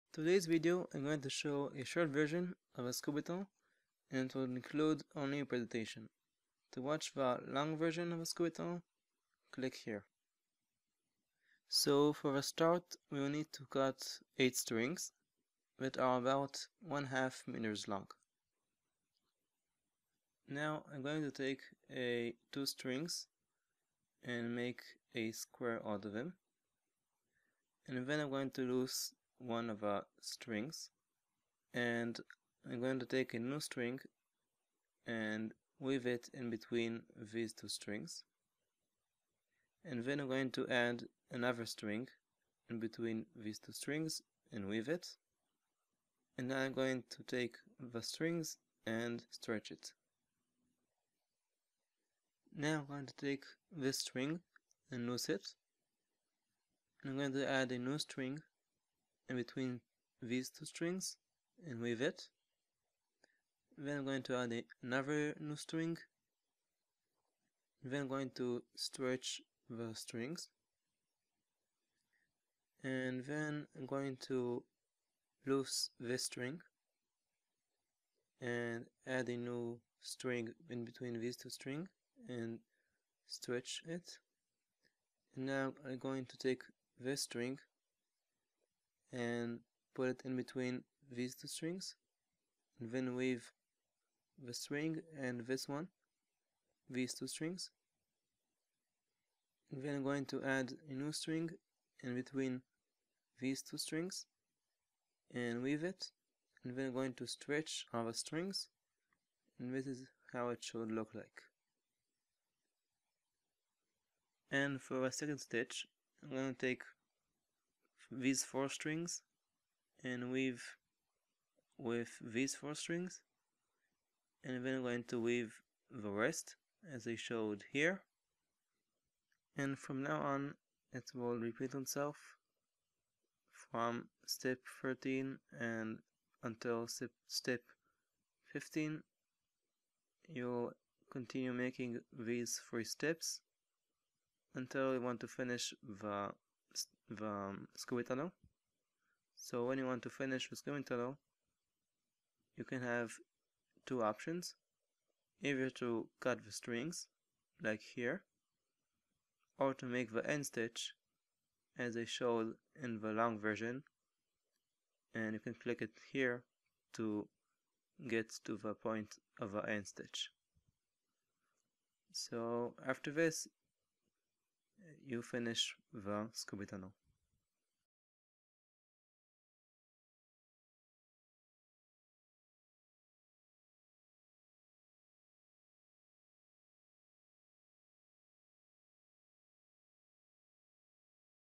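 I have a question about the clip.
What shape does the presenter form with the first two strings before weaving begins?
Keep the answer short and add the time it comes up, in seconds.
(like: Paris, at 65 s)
A square, at 25 s.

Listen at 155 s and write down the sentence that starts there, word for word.
Either to cut the strings, like here, or to make the end stitch, as I showed in the long version.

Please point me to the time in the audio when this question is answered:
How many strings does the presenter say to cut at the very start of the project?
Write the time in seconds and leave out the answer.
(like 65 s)
14 s.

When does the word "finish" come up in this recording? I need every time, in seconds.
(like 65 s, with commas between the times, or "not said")
145 s, 150 s, 175 s.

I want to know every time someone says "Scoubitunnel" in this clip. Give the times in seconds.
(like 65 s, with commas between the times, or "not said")
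2 s, 8 s, 150 s.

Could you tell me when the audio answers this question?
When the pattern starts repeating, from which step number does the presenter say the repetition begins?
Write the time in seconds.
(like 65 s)
134 s.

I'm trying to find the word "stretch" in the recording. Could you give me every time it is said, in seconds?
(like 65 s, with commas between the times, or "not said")
49 s, 68 s, 83 s, 107 s.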